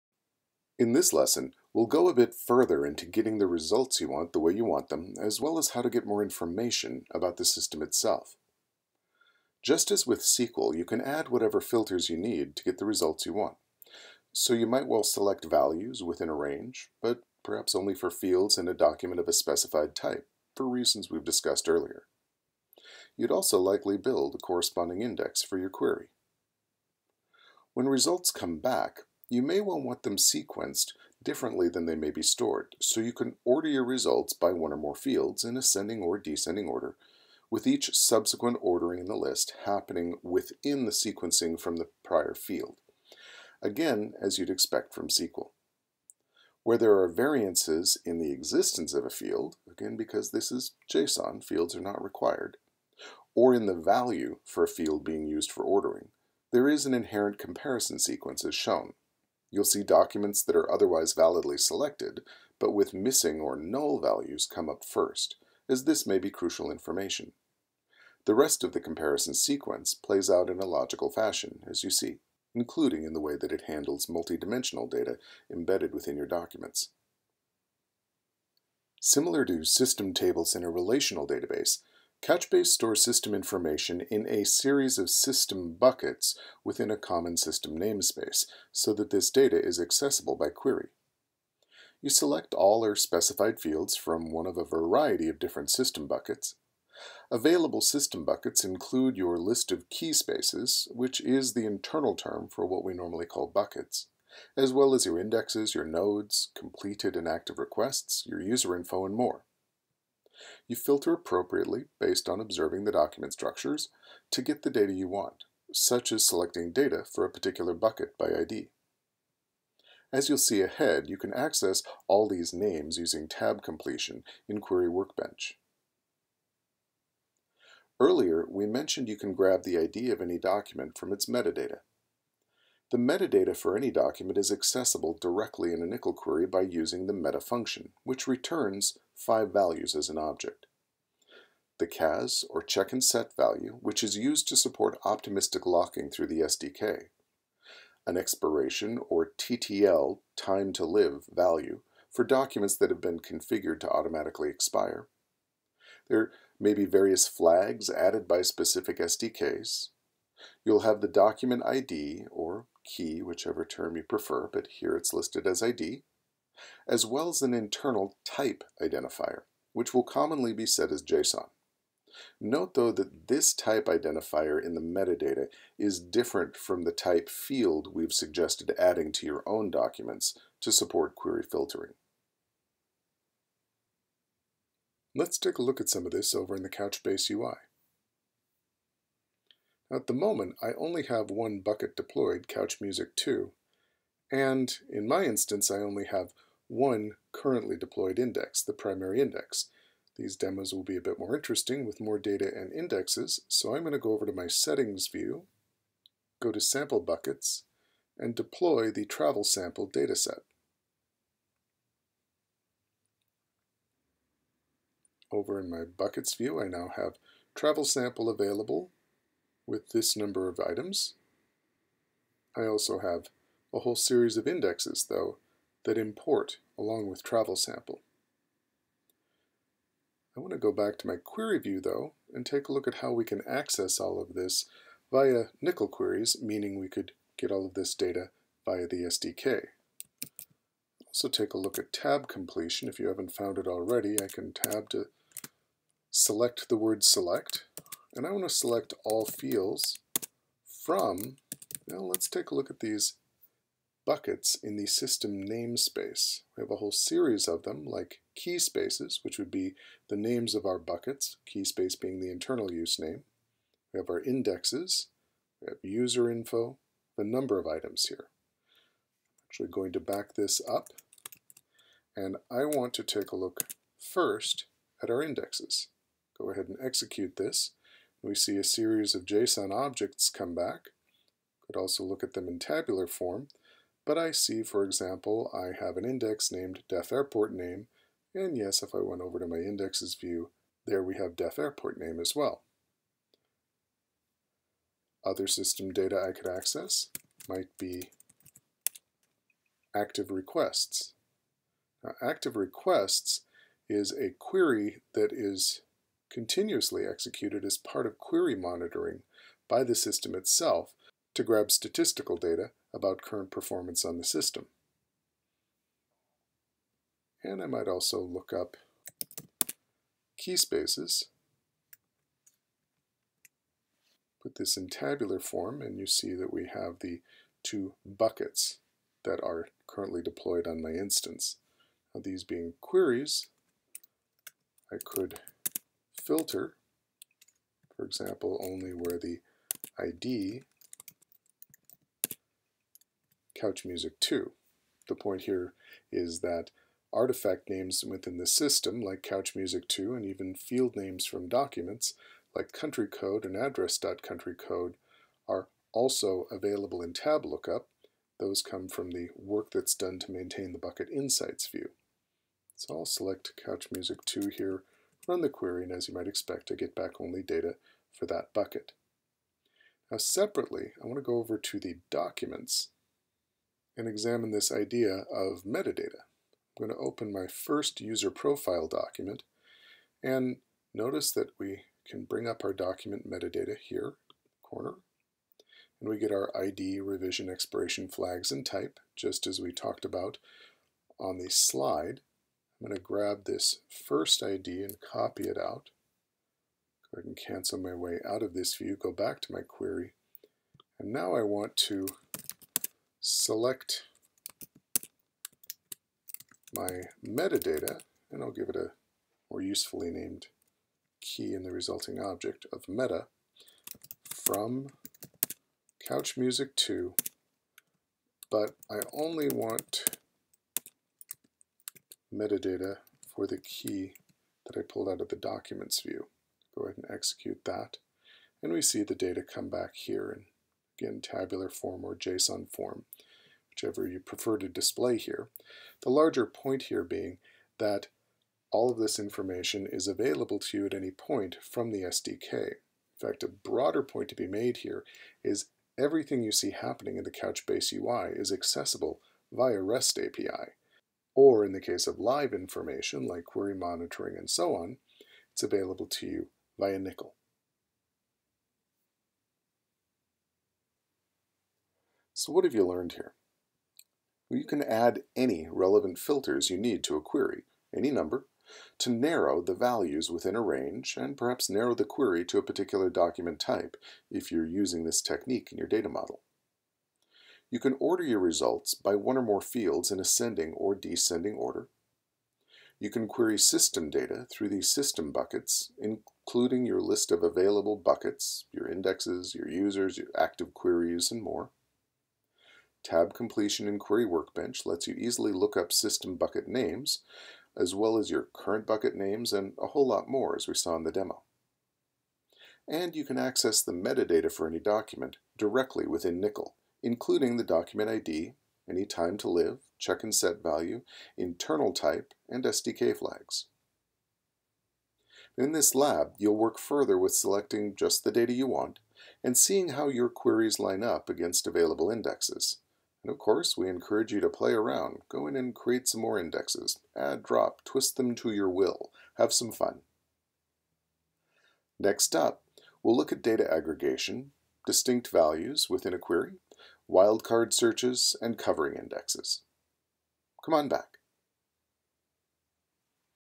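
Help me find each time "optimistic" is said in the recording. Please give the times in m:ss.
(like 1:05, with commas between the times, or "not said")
2:25.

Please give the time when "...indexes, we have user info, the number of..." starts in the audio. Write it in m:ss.
4:24.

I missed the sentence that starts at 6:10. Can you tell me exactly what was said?
Now separately, I want to go over to the documents and examine this idea of metadata.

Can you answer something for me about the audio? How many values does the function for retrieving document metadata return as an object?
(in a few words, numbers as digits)
5.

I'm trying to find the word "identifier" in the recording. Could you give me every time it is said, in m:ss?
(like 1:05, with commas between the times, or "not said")
2:48, 2:53.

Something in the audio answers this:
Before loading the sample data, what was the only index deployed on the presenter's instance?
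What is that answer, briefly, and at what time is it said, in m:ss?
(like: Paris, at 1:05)
The primary index, at 3:18.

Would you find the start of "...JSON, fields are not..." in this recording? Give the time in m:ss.
0:50.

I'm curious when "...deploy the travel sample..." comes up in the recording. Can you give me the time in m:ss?
3:28.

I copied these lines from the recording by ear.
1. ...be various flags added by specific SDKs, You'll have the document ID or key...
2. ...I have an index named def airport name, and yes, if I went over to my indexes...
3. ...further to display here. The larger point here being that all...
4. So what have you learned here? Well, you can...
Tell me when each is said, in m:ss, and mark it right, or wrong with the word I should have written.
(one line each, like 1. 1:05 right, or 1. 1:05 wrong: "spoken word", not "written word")
1. 2:36 right
2. 4:45 right
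3. 7:14 wrong: "prefer", not "further"
4. 7:42 right.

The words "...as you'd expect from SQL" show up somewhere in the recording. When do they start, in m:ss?
0:44.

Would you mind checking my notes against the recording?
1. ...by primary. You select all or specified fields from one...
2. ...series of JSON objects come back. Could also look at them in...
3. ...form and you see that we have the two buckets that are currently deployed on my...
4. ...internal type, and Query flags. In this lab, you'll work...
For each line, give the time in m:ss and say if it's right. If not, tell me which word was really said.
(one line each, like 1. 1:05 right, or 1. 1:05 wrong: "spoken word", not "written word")
1. 1:30 wrong: "query", not "primary"
2. 4:38 right
3. 5:25 right
4. 8:31 wrong: "SDK", not "Query".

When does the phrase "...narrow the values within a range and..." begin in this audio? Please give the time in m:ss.
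7:49.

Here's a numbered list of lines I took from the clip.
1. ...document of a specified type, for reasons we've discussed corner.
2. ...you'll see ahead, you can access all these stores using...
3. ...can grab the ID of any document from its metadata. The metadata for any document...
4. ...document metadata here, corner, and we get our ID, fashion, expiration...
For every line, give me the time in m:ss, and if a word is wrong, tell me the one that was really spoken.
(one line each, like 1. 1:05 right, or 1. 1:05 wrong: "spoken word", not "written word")
1. 0:18 wrong: "earlier", not "corner"
2. 2:00 wrong: "names", not "stores"
3. 2:09 right
4. 6:22 wrong: "revision", not "fashion".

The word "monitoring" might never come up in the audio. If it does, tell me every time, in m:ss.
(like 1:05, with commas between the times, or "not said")
5:08, 7:33.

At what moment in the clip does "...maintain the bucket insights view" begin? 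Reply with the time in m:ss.
6:00.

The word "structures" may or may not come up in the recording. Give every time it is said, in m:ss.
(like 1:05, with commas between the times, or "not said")
1:53.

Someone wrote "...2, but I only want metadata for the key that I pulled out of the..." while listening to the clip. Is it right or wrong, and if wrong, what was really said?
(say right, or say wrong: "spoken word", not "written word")
right.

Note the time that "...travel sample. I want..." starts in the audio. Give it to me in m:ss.
3:47.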